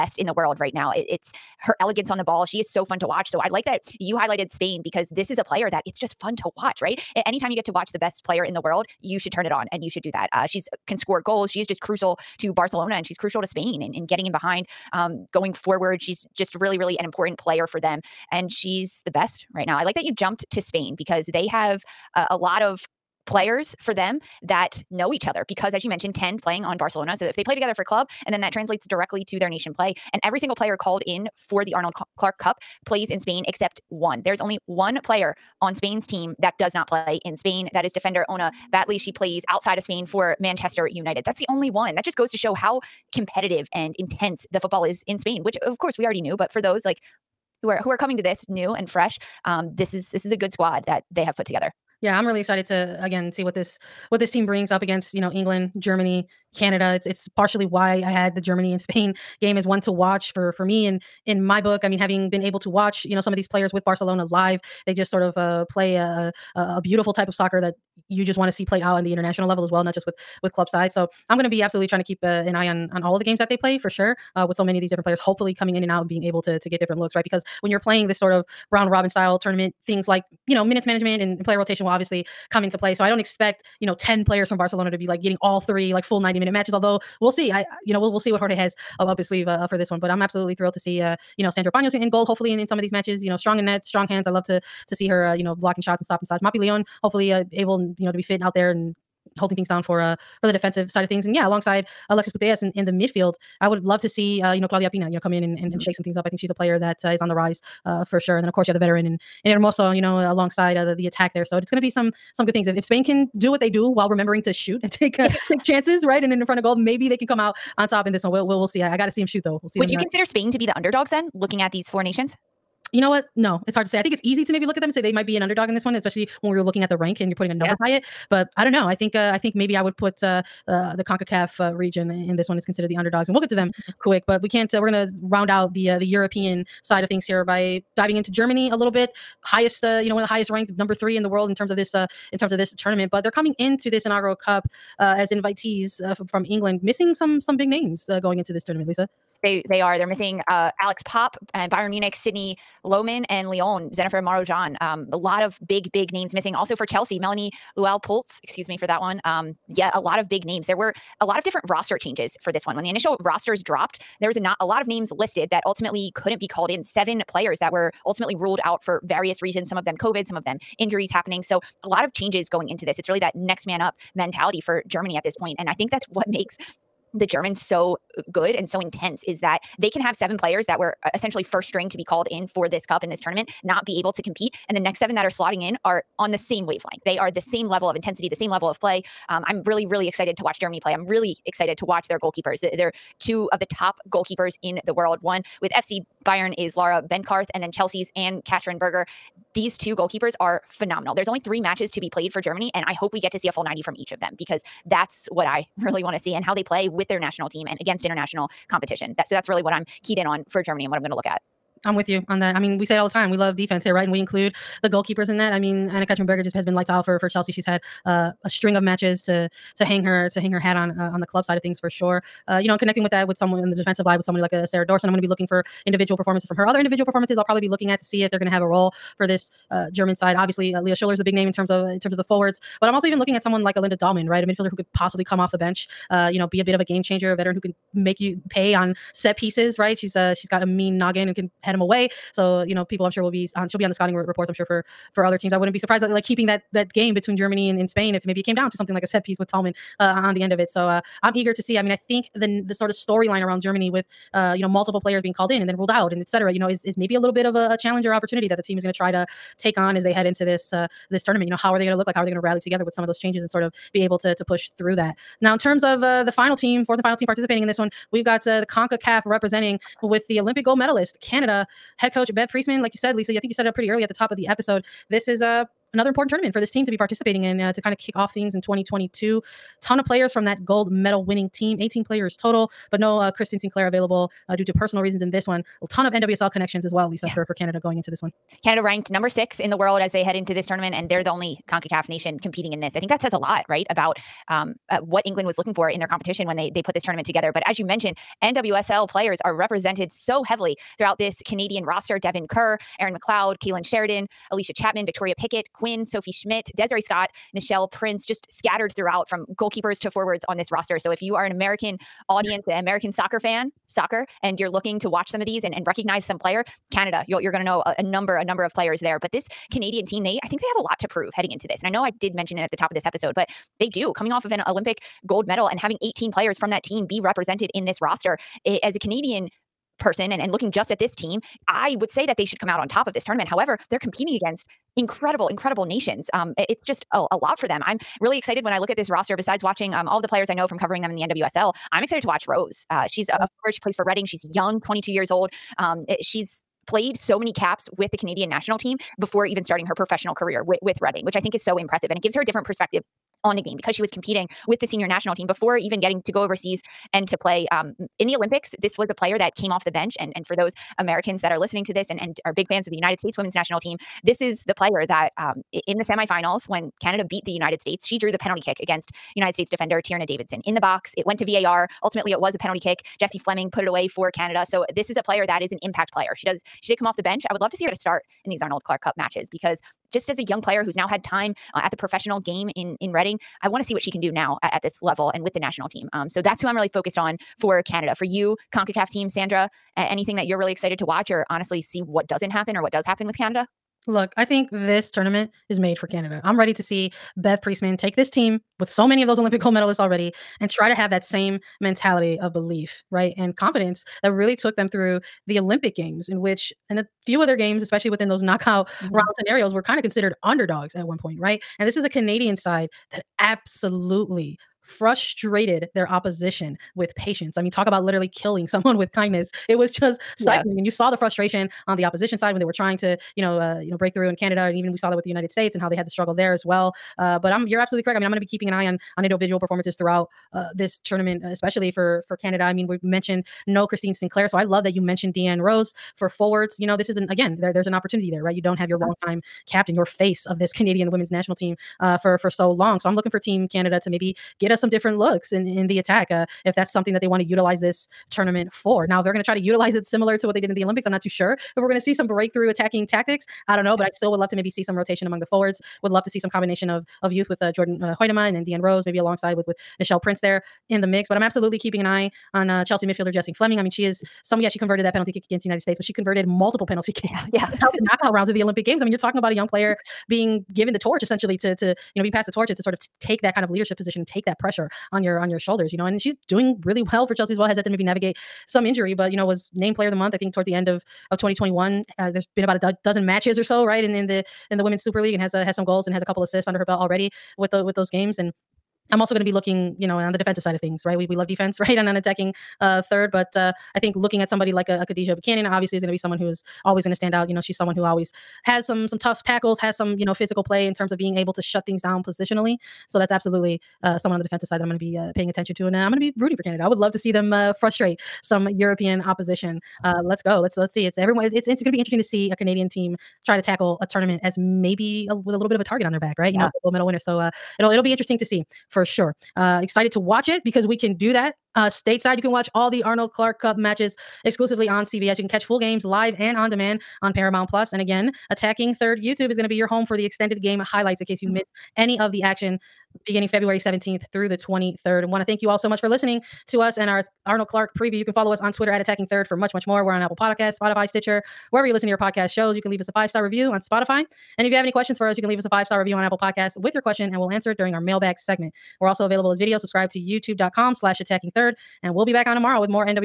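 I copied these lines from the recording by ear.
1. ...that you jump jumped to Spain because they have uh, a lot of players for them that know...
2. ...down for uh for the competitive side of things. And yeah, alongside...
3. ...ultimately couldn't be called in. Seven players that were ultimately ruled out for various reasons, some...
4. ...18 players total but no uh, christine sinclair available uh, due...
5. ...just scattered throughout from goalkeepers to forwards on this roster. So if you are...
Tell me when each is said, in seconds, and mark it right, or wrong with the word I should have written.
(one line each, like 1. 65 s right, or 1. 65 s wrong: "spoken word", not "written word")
1. 19 s right
2. 99 s wrong: "defensive", not "competitive"
3. 165 s right
4. 281 s right
5. 308 s right.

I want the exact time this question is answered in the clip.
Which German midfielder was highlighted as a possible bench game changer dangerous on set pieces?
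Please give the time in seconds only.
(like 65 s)
233 s.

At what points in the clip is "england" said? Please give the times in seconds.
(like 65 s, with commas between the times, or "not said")
55 s, 146 s, 295 s.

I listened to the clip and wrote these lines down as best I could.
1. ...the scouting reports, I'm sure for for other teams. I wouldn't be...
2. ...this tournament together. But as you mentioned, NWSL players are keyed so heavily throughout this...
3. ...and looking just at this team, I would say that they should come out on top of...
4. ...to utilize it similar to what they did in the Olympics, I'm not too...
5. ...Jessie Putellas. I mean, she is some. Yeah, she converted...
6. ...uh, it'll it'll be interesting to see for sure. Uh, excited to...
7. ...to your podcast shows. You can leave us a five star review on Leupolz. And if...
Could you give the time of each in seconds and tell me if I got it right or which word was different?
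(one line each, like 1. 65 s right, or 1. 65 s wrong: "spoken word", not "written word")
1. 243 s right
2. 296 s wrong: "represented", not "keyed"
3. 330 s right
4. 449 s right
5. 463 s wrong: "Fleming", not "Putellas"
6. 517 s right
7. 542 s wrong: "Spotify", not "Leupolz".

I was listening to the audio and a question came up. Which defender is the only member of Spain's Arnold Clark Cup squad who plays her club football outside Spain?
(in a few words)
Ona Batlle.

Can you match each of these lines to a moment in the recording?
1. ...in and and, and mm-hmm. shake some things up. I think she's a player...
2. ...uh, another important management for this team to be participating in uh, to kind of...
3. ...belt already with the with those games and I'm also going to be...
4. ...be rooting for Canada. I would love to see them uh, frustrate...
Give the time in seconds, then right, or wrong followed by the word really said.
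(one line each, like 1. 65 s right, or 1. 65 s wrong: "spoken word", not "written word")
1. 105 s right
2. 275 s wrong: "tournament", not "management"
3. 486 s right
4. 506 s right.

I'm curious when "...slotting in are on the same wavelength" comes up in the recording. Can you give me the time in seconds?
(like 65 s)
185 s.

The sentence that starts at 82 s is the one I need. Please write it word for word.
So I don't expect, you know, 10 players from Barcelona to be like getting all three like full 90 minute matches.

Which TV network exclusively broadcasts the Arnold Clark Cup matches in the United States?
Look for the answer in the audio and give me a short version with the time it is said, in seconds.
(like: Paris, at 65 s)
CBS, at 525 s.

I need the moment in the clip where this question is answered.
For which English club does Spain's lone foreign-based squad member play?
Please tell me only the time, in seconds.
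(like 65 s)
40 s.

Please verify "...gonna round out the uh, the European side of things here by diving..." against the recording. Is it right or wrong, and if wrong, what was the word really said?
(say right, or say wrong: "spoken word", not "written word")
right.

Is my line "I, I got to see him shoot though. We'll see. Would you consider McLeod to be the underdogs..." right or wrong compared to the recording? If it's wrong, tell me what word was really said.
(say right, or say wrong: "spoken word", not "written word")
wrong: "Spain", not "McLeod".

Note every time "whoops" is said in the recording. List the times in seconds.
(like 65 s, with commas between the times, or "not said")
not said.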